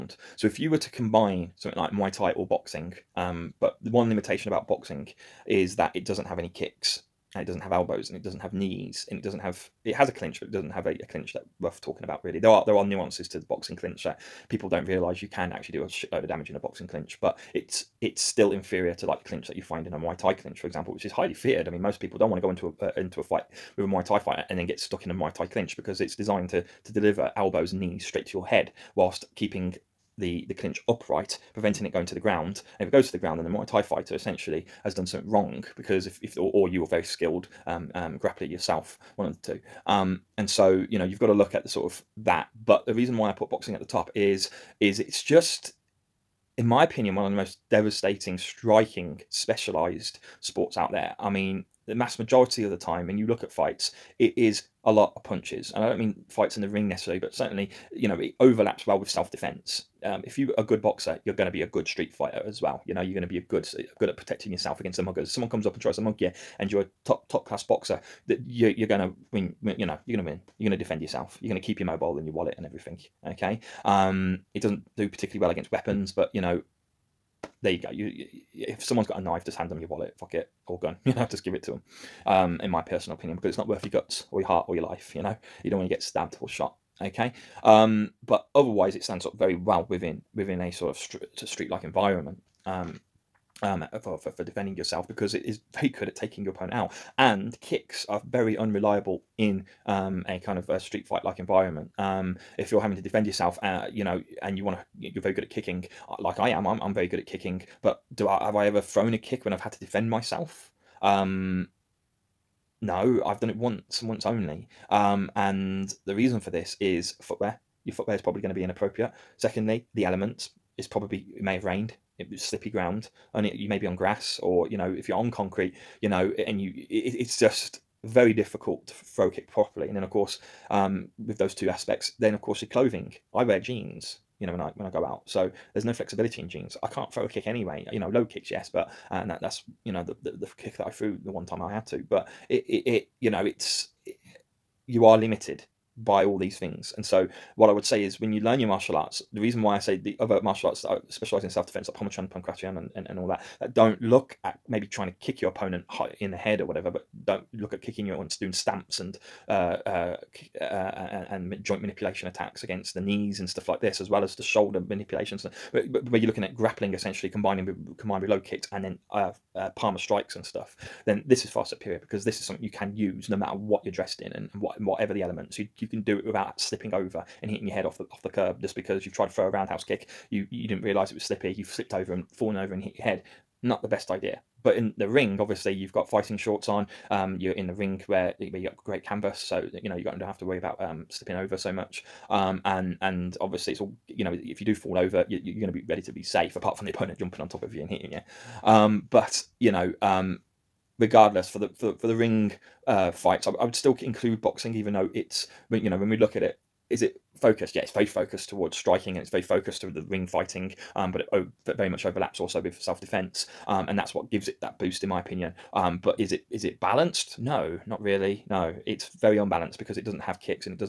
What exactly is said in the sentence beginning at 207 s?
Yeah, it's very focused towards striking and it's very focused to the ring fighting.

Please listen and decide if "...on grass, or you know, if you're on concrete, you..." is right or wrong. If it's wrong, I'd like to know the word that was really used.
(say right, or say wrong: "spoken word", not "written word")
right.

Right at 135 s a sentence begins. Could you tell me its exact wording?
So there's no flexibility in jeans.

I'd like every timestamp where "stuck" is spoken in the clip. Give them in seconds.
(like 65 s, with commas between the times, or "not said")
24 s.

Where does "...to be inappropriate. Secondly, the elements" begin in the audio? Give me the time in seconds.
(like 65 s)
118 s.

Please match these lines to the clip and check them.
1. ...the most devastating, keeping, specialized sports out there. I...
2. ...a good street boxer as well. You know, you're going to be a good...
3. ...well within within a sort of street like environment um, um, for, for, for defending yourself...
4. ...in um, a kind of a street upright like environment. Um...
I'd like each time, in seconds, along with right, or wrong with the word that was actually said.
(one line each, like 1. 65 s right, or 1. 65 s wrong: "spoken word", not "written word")
1. 47 s wrong: "striking", not "keeping"
2. 61 s wrong: "fighter", not "boxer"
3. 89 s right
4. 99 s wrong: "fight", not "upright".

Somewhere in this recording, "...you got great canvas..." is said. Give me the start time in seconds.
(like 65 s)
188 s.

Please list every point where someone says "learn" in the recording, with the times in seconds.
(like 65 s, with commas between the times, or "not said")
148 s.